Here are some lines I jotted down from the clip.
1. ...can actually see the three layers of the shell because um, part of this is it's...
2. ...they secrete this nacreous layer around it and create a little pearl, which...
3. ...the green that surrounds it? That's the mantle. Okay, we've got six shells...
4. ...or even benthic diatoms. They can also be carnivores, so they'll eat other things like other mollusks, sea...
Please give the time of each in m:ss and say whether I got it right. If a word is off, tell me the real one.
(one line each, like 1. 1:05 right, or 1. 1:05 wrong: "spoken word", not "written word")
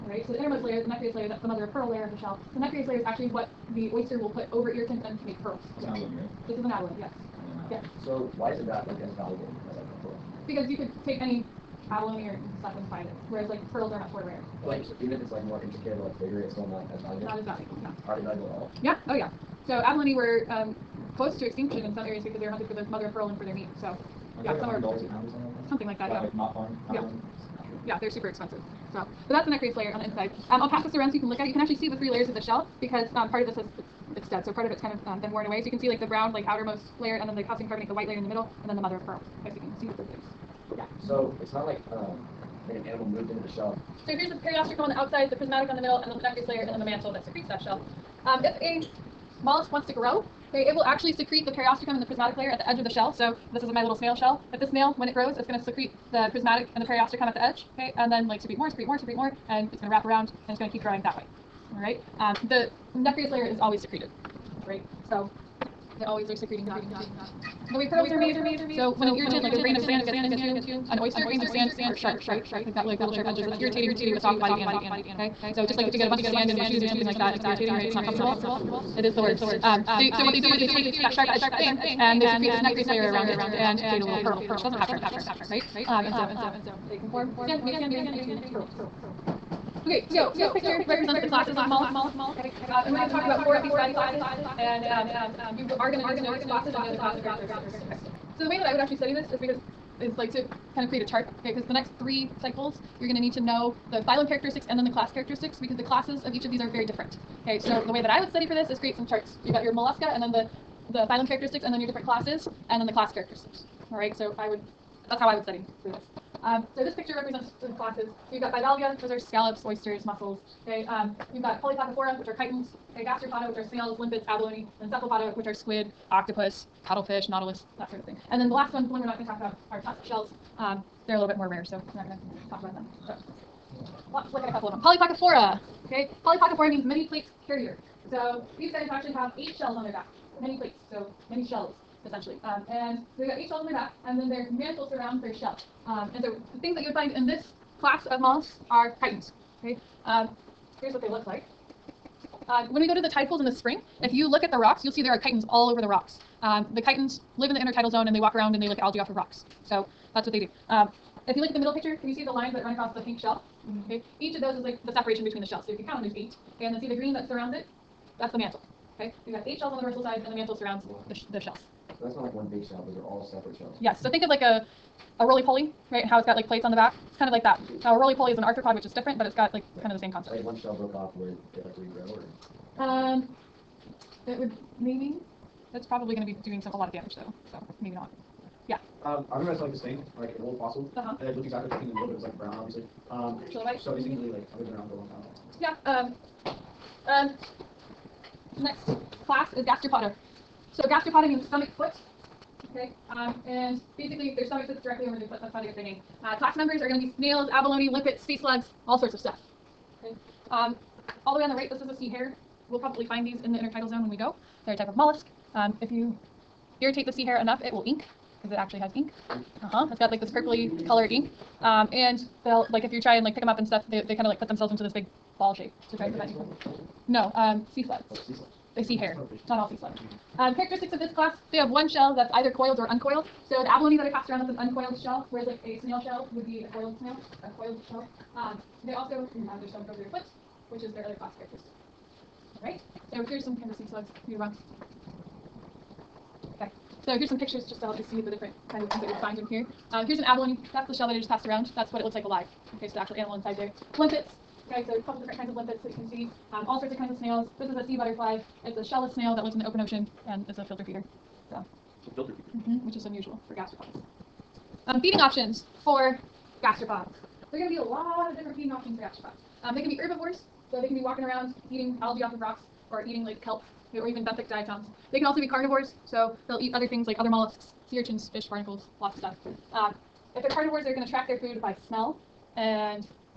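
1. 0:31 right
2. 1:22 right
3. 2:46 wrong: "eight", not "six"
4. 4:33 right.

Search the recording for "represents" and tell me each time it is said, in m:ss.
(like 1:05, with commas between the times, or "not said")
1:30, 1:57.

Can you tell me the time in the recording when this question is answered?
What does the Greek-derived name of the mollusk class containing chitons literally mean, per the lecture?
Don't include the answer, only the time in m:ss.
2:16.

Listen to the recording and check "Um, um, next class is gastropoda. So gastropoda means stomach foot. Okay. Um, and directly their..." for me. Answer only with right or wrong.
wrong.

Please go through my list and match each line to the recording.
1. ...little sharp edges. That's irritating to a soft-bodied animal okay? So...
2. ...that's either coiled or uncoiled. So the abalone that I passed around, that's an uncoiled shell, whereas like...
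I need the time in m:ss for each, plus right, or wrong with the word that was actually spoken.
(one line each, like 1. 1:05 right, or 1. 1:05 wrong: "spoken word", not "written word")
1. 1:12 right
2. 3:52 right.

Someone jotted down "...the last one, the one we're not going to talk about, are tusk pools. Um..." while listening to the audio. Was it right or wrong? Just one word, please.
wrong.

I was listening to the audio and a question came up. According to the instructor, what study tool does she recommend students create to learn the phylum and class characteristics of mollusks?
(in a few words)
Charts.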